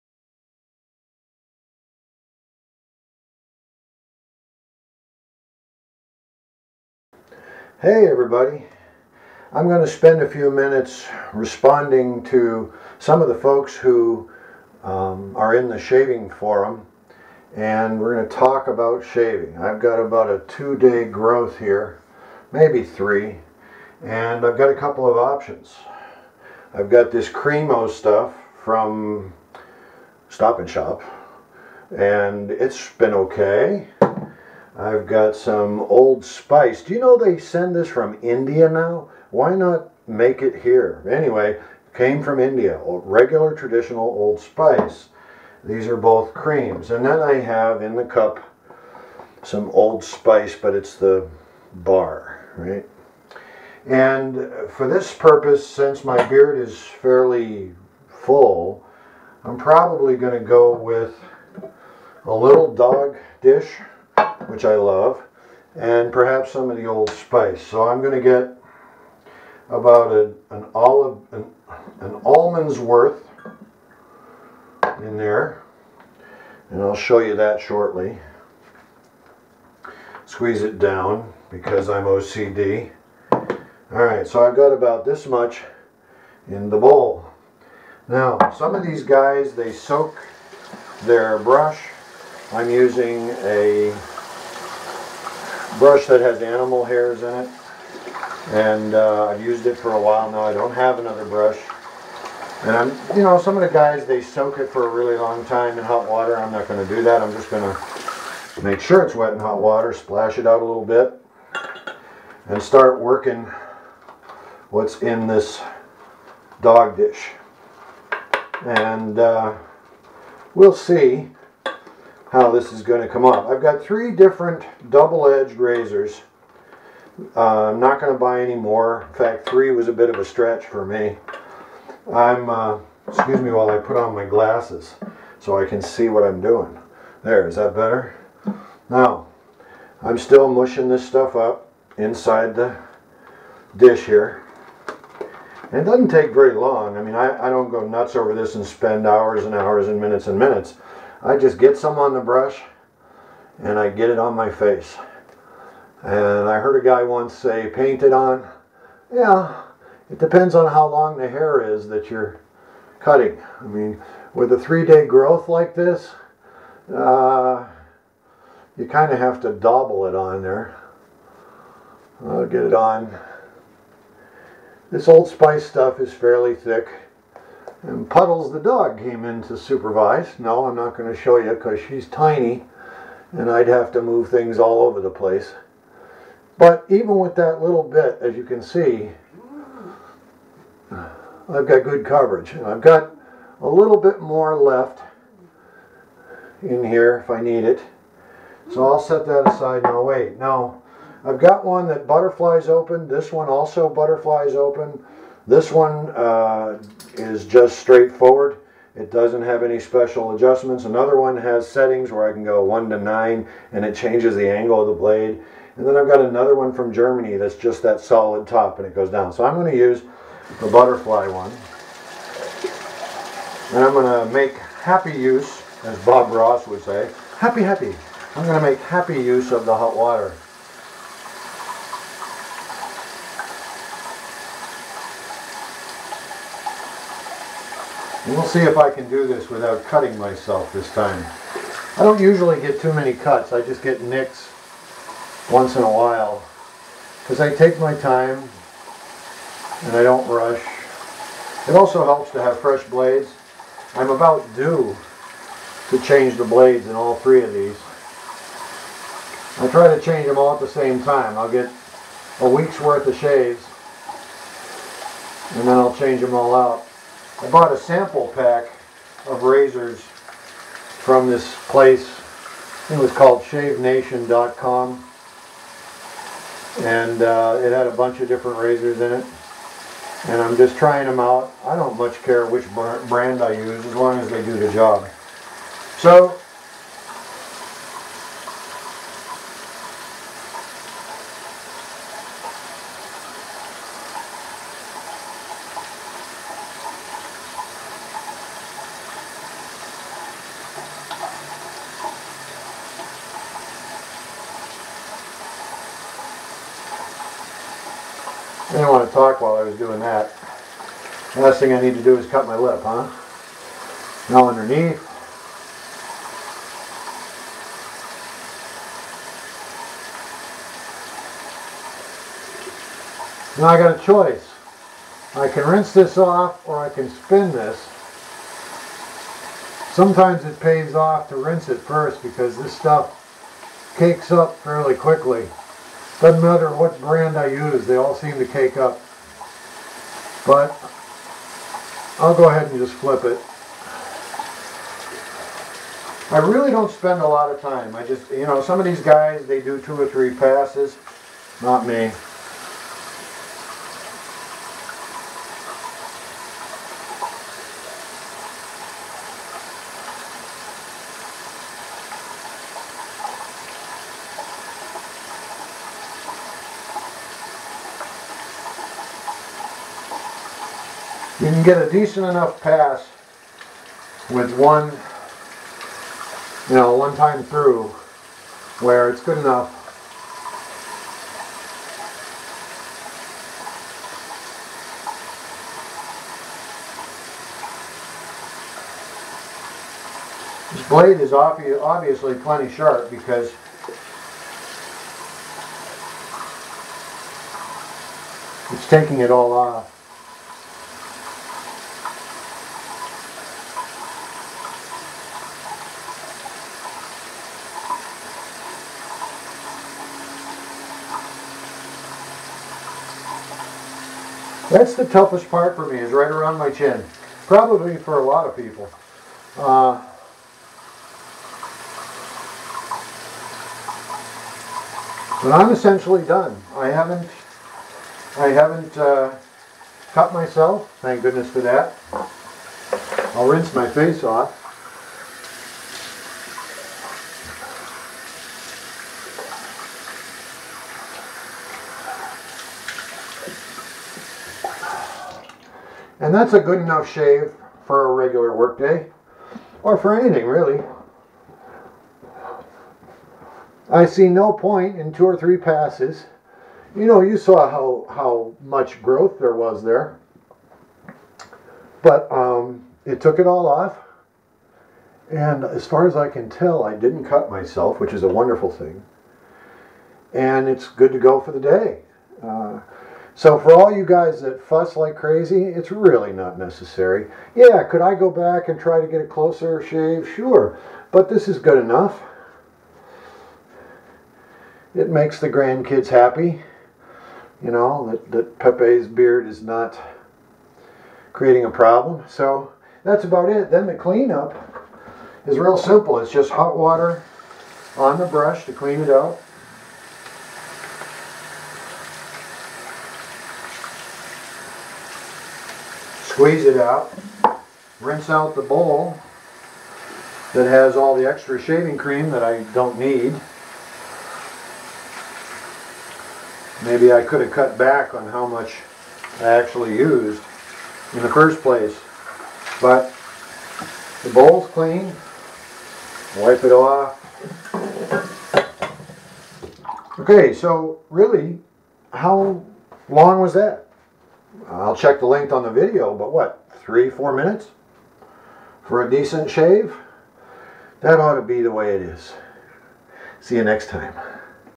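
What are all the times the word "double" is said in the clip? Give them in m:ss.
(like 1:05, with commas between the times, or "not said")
2:04, 2:49.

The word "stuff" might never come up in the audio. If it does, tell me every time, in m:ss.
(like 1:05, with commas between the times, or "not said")
0:27, 2:21, 2:55, 5:32.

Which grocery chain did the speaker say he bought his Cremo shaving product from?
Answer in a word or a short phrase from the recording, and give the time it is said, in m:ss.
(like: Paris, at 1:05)
Stop and Shop, at 0:30.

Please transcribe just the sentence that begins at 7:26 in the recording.
And that's a good enough shave for a regular workday, or for anything really.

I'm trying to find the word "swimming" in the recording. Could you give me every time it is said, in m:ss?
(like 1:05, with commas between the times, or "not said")
not said.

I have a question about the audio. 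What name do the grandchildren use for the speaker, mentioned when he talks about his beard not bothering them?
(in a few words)
Pepe.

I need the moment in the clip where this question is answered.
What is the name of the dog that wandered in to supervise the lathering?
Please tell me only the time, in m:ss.
2:58.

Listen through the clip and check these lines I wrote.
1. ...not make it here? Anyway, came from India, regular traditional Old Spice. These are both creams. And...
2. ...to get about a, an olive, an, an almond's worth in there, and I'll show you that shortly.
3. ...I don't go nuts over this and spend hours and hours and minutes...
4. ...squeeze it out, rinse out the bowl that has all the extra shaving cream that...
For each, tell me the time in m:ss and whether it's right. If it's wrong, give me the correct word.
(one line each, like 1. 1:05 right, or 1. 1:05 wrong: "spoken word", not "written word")
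1. 0:39 right
2. 1:08 right
3. 2:27 right
4. 8:26 right.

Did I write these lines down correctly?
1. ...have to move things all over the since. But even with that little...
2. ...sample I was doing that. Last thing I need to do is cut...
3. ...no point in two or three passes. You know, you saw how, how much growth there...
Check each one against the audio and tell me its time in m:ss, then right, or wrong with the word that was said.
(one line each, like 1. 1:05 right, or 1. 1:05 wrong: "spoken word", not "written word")
1. 3:03 wrong: "place", not "since"
2. 5:09 wrong: "while", not "sample"
3. 7:34 right.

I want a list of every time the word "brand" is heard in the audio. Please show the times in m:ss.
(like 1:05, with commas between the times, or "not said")
4:43, 5:37.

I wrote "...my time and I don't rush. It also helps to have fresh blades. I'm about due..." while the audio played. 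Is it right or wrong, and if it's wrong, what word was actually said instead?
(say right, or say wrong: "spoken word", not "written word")
right.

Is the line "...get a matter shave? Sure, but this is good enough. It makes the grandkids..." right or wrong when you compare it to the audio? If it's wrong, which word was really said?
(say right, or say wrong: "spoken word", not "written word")
wrong: "closer", not "matter".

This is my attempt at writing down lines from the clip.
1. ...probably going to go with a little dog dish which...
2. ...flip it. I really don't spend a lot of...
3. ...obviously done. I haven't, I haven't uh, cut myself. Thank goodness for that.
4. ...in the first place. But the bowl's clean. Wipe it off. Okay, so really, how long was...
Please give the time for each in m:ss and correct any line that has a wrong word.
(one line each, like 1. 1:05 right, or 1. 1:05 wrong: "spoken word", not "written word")
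1. 0:59 right
2. 5:42 right
3. 7:05 wrong: "essentially", not "obviously"
4. 8:41 right.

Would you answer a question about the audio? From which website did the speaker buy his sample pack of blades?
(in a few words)
ShaveNation.com.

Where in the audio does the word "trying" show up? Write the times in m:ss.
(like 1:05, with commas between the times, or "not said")
4:40.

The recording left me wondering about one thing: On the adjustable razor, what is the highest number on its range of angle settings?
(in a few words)
9.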